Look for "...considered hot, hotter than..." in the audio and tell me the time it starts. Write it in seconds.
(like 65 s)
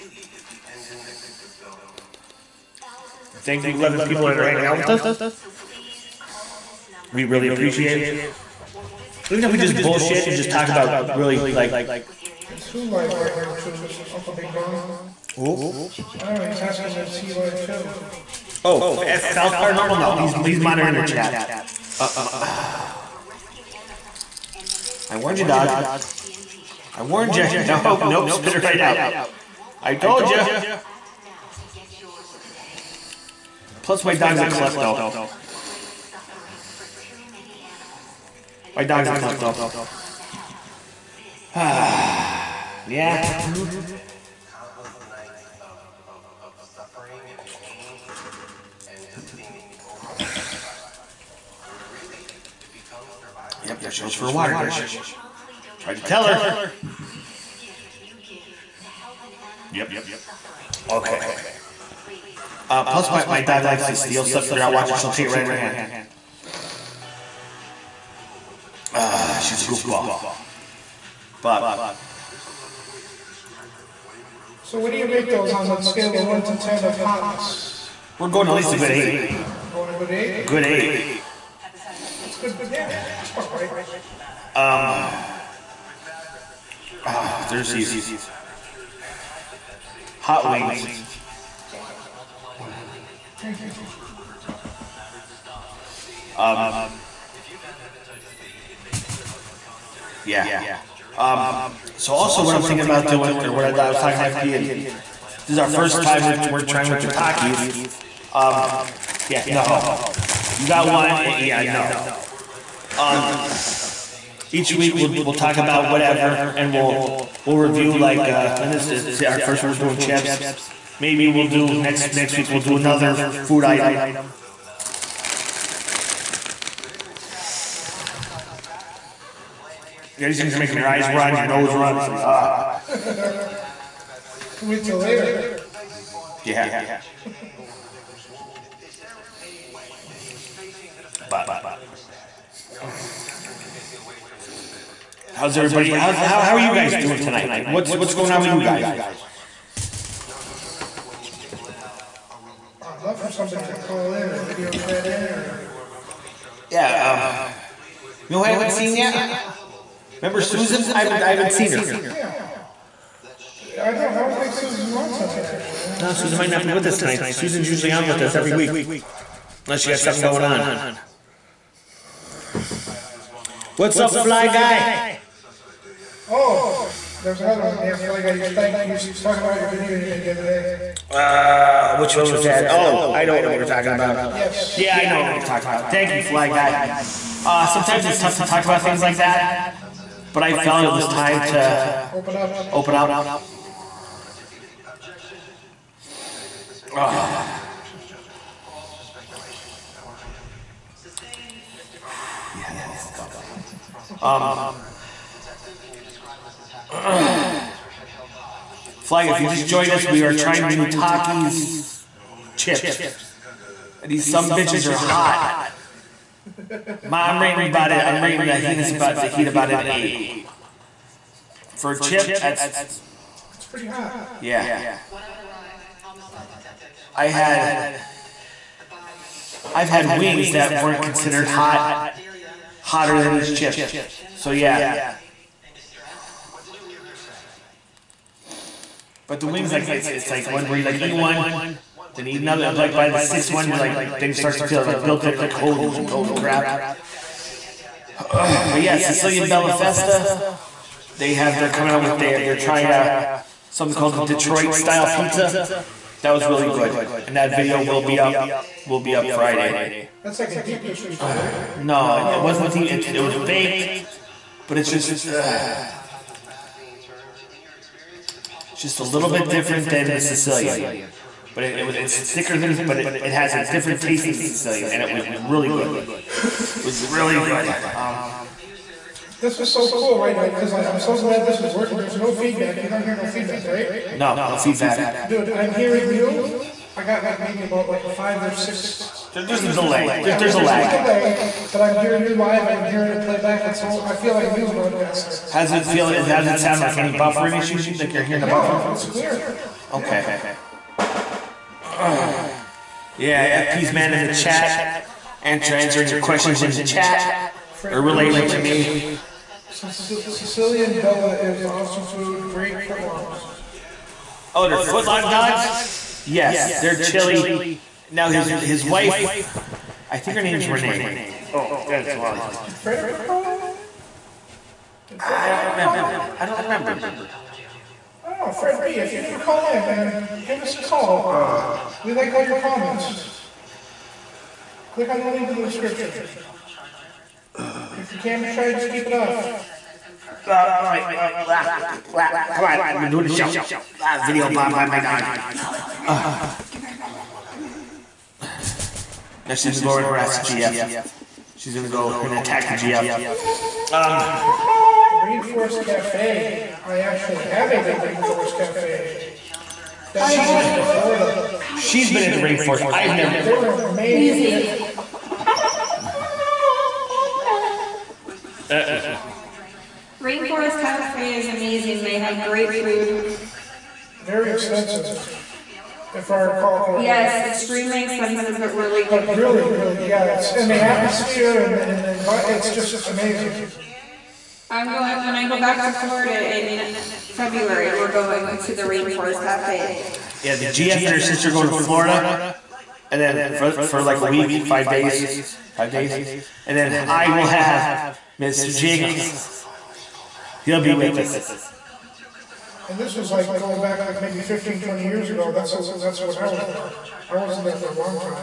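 231 s.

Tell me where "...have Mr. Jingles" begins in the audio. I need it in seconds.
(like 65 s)
397 s.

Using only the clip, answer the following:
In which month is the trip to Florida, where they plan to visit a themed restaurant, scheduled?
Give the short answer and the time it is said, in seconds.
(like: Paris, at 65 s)
February, at 386 s.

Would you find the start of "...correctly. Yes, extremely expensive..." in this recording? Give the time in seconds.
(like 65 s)
376 s.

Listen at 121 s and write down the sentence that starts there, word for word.
Maybe we'll do next next week we'll do another food item.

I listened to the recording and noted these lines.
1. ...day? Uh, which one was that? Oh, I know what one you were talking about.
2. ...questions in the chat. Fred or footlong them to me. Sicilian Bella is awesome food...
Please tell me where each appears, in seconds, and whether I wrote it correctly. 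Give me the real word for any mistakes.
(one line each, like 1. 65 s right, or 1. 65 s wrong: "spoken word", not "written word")
1. 180 s right
2. 306 s wrong: "relating", not "footlong".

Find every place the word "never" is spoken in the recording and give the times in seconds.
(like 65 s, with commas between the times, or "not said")
329 s, 363 s.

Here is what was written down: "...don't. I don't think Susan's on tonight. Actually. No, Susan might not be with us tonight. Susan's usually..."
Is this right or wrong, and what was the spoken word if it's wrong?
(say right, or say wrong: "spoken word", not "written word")
right.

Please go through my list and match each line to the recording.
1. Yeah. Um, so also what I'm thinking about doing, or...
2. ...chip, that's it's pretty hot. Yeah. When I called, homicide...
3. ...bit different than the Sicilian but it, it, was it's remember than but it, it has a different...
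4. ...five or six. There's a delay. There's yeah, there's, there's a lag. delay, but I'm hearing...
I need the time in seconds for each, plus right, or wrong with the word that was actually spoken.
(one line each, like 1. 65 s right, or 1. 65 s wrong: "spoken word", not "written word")
1. 100 s right
2. 222 s wrong: "arrived", not "called"
3. 269 s wrong: "thicker", not "remember"
4. 288 s right.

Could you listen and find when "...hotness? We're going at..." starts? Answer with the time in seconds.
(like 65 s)
76 s.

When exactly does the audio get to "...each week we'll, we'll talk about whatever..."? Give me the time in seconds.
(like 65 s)
114 s.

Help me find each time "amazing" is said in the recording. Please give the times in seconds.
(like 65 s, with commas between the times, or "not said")
363 s, 371 s, 383 s.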